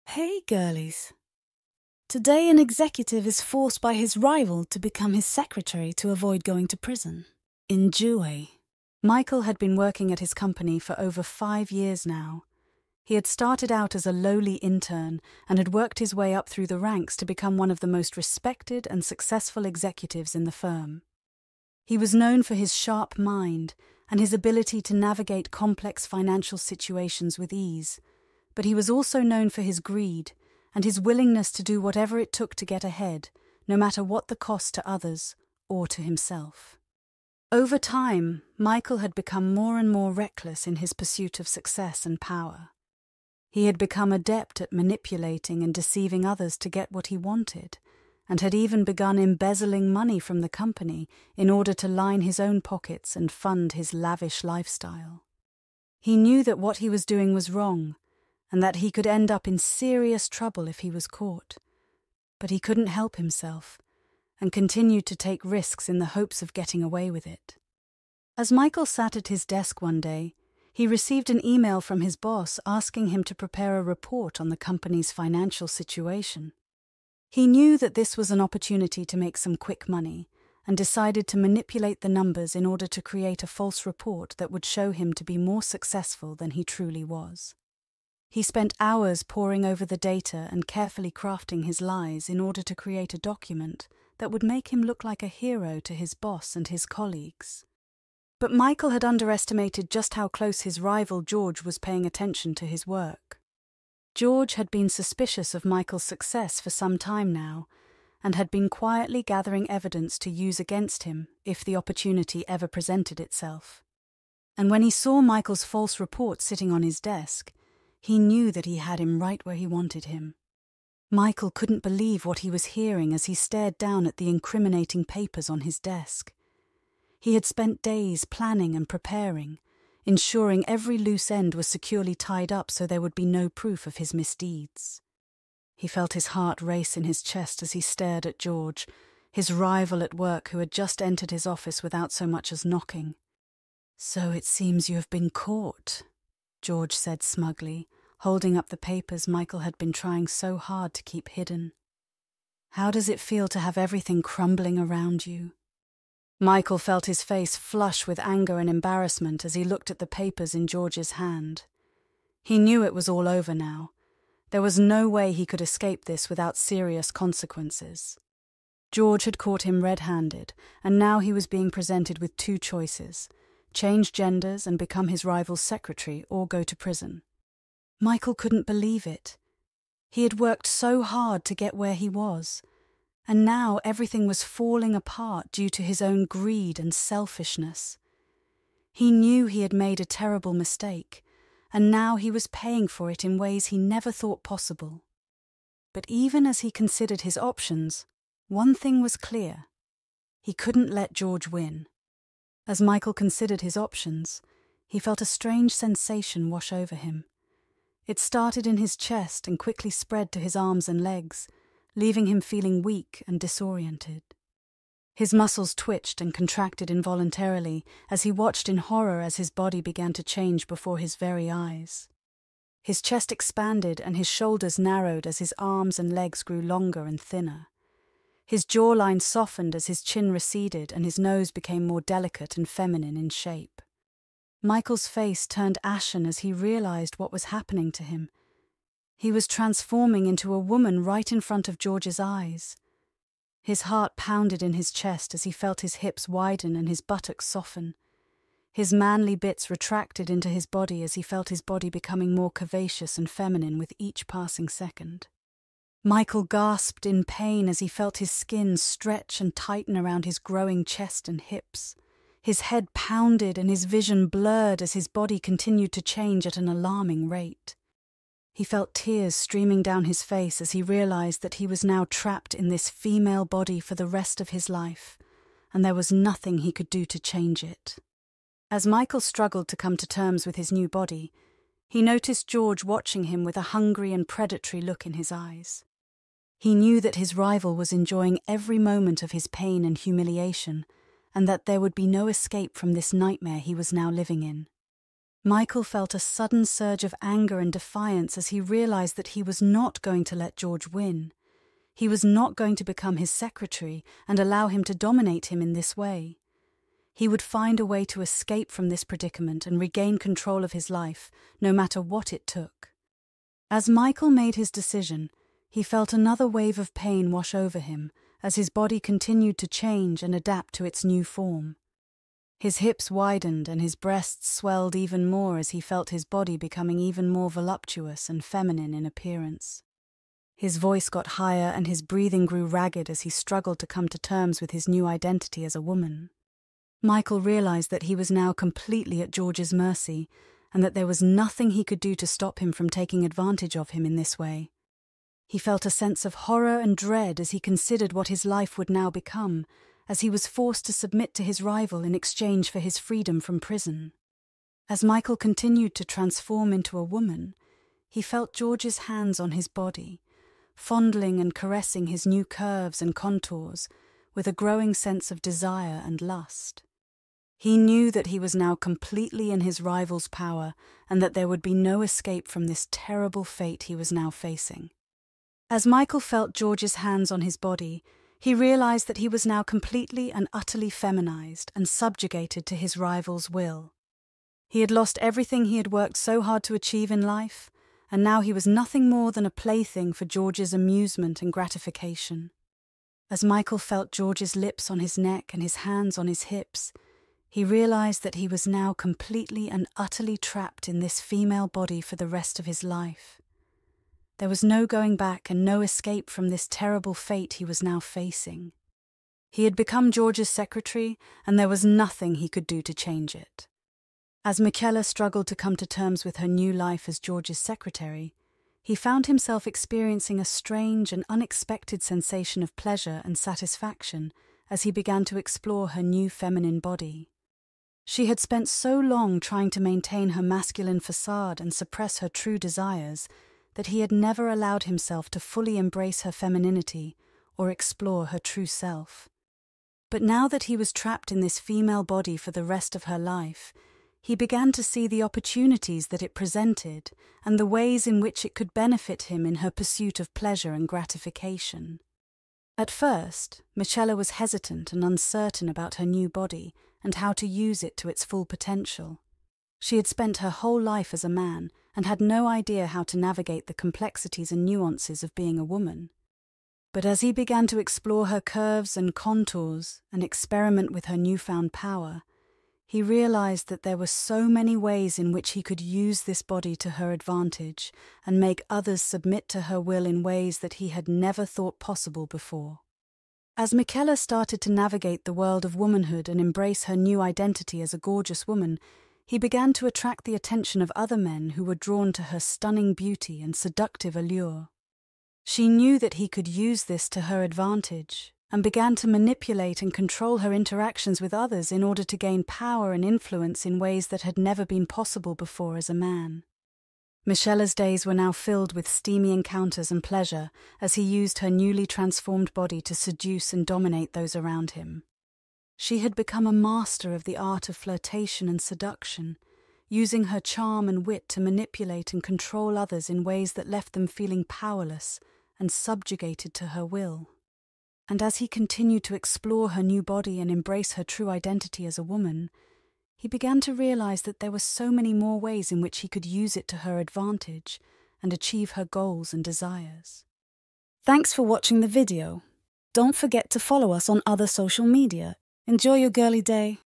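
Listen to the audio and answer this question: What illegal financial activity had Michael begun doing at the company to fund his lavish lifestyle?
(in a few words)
embezzling money.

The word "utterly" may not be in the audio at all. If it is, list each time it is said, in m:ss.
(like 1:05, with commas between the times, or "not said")
6:20, 6:39.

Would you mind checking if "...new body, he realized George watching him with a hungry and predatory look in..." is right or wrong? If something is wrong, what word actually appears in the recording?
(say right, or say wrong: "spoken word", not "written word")
wrong: "noticed", not "realized".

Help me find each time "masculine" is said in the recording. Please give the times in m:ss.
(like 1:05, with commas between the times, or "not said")
7:10.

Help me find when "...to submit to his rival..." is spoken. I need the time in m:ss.
5:50.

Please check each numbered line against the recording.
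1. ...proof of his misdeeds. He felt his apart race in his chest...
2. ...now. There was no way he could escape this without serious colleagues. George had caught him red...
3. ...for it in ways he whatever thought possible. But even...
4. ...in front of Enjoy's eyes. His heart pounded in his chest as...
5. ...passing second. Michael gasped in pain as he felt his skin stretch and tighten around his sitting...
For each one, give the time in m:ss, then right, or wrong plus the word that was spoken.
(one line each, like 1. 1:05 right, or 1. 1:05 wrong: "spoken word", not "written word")
1. 2:13 wrong: "heart", not "apart"
2. 2:43 wrong: "consequences", not "colleagues"
3. 3:12 wrong: "never", not "whatever"
4. 4:01 wrong: "George", not "Enjoy"
5. 4:14 wrong: "growing", not "sitting".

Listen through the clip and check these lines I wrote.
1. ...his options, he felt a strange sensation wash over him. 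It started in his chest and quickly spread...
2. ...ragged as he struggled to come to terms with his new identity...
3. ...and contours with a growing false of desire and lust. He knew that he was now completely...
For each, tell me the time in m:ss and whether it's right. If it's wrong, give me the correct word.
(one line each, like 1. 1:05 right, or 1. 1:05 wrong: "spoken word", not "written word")
1. 3:23 right
2. 5:32 right
3. 6:03 wrong: "sense", not "false".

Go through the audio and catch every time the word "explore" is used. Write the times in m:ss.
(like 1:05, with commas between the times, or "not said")
7:05, 7:17, 7:47, 8:49.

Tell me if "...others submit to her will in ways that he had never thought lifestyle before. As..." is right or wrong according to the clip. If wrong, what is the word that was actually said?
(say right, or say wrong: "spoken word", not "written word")
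wrong: "possible", not "lifestyle".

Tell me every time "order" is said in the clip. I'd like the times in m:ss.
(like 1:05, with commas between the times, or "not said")
0:51, 1:22, 1:32, 8:21.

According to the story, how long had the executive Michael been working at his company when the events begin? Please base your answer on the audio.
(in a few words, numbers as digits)
over five years.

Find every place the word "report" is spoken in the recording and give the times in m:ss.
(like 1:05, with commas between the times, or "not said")
1:13, 1:23, 1:55.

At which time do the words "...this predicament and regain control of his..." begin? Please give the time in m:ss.
5:08.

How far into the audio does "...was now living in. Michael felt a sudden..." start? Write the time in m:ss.
4:53.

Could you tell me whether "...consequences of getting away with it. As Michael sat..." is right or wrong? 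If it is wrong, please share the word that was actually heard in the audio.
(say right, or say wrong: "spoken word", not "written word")
wrong: "hopes", not "consequences".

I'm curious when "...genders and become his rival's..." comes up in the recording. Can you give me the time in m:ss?
2:54.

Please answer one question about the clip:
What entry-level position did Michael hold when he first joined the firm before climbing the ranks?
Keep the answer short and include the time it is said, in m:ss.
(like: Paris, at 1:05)
intern, at 0:14.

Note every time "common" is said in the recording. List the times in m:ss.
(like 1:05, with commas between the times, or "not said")
not said.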